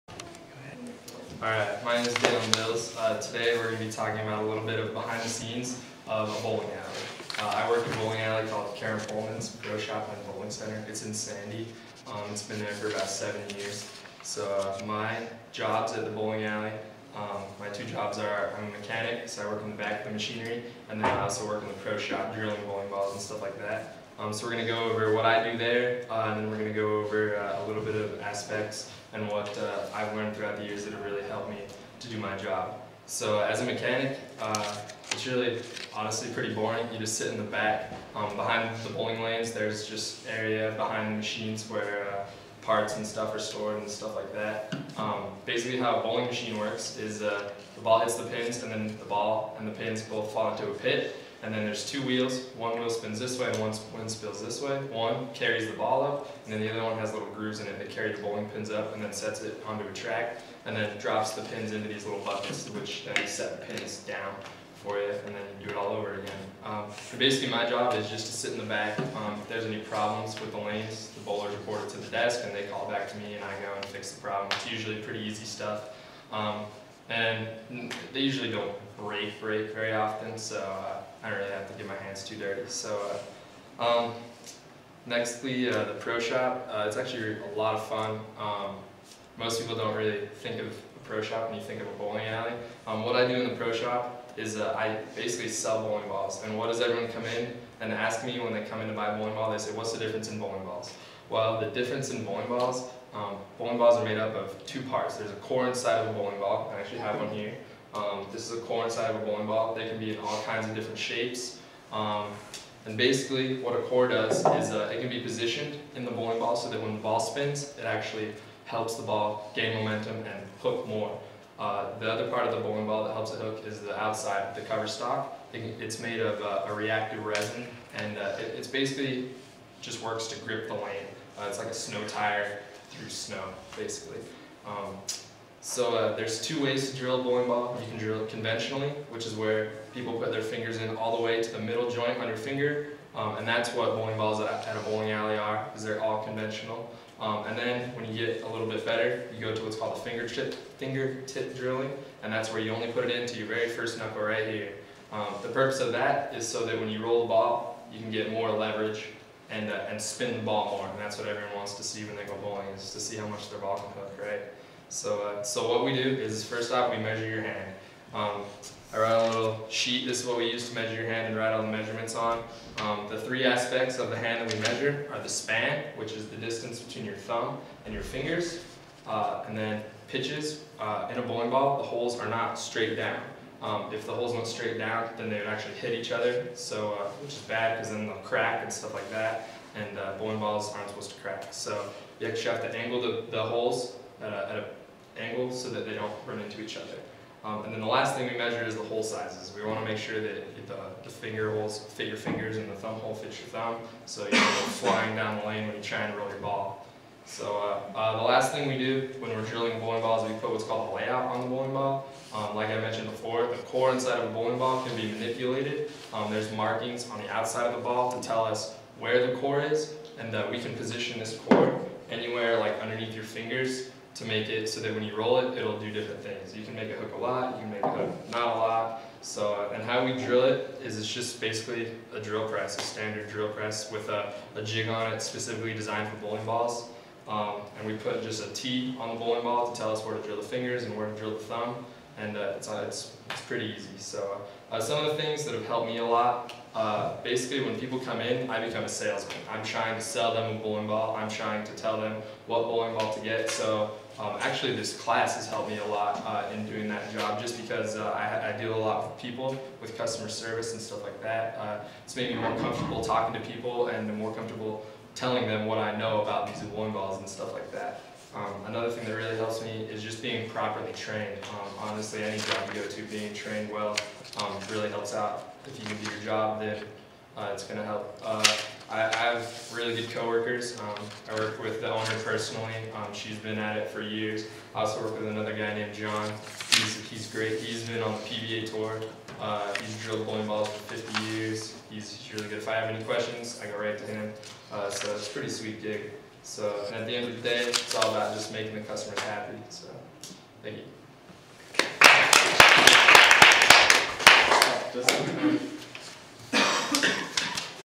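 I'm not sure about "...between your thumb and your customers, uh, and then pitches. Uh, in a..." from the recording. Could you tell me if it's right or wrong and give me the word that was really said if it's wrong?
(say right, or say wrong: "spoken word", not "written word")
wrong: "fingers", not "customers".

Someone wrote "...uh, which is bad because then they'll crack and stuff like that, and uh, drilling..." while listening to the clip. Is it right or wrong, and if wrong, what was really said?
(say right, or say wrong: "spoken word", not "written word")
wrong: "bowling", not "drilling".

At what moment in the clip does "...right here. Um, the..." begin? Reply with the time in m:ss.
2:34.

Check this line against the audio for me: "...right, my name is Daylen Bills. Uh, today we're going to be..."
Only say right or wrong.
right.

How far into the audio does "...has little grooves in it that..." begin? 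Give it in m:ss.
0:56.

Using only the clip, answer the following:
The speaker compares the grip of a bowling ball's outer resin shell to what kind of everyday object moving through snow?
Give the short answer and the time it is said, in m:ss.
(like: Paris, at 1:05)
A snow tire, at 2:11.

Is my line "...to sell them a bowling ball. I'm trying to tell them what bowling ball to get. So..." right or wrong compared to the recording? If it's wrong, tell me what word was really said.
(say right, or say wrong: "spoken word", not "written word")
right.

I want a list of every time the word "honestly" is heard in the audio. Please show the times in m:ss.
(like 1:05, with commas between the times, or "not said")
0:35, 4:31.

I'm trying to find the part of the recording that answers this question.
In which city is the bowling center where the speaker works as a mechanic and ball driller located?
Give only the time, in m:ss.
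0:11.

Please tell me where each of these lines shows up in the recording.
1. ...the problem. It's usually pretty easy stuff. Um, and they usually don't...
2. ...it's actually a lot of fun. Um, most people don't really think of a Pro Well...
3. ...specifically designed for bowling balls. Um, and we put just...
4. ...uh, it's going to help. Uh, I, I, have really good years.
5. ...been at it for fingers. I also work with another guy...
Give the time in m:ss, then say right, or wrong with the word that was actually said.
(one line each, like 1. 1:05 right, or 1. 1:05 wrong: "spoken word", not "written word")
1. 1:14 right
2. 1:26 wrong: "Shop", not "Well"
3. 3:55 right
4. 4:37 wrong: "coworkers", not "years"
5. 4:43 wrong: "years", not "fingers".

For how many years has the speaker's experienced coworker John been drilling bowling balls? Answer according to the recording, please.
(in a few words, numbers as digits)
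50.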